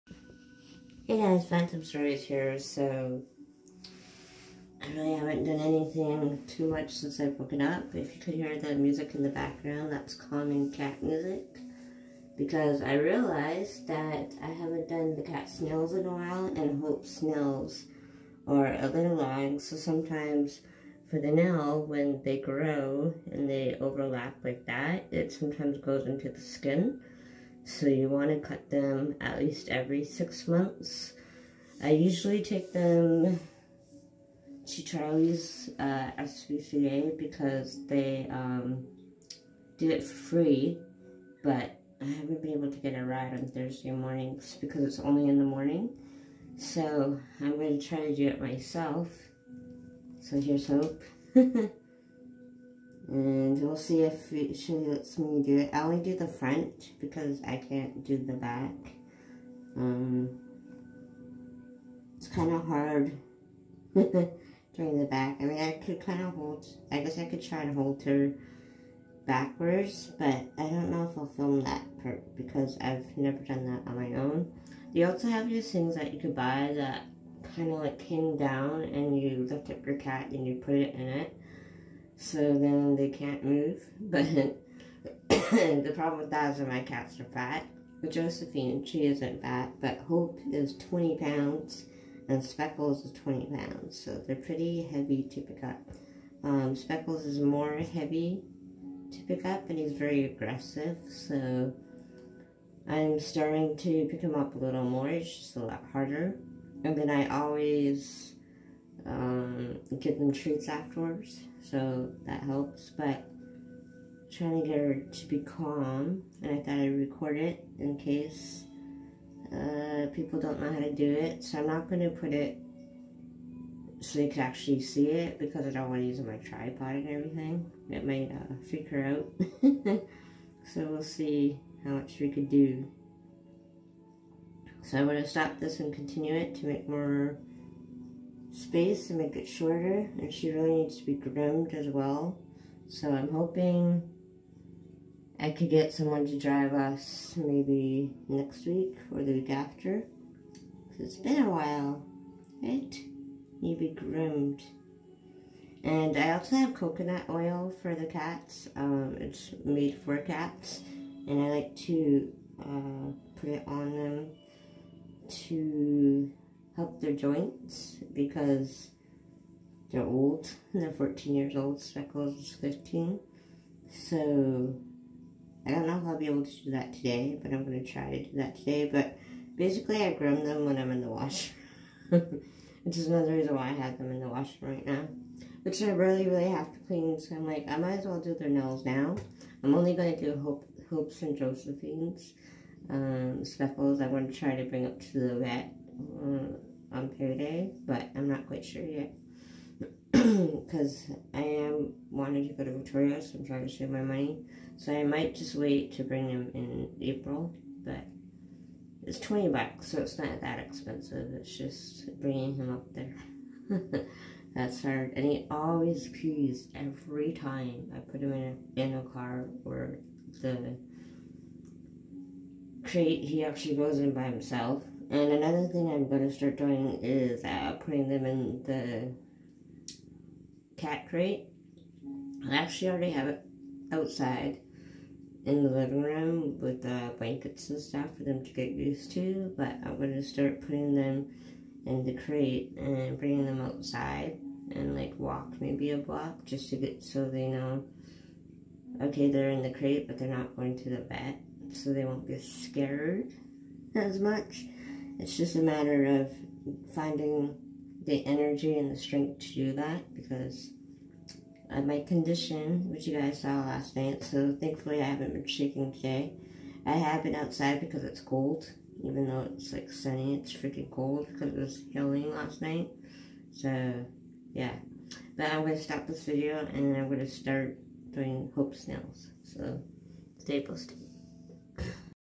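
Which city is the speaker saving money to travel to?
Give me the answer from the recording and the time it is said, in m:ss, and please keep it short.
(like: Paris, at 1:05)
Victoria, at 3:22.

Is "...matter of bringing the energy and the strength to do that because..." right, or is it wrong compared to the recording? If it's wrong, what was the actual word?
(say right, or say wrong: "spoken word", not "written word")
wrong: "finding", not "bringing".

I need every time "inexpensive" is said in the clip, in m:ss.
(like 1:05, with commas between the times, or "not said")
not said.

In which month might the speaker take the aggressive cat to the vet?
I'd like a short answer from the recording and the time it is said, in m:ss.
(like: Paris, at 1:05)
April, at 3:27.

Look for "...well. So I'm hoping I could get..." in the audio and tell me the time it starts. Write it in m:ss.
2:21.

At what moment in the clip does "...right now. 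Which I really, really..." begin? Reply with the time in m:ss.
3:04.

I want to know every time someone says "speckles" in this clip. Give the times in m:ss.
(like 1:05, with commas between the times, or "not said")
1:32, 1:36, 2:51, 3:13.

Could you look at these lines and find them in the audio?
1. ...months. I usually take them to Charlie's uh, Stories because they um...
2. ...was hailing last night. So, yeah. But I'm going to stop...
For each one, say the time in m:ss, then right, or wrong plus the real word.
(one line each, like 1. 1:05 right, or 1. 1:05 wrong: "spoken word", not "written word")
1. 0:30 wrong: "SPCA", not "Stories"
2. 4:31 right.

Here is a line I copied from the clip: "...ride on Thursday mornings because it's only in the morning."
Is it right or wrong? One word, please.
right.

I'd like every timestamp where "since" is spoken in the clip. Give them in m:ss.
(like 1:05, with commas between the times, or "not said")
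0:06.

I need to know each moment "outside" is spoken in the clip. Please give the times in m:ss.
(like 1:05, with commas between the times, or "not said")
3:53, 4:03, 4:27.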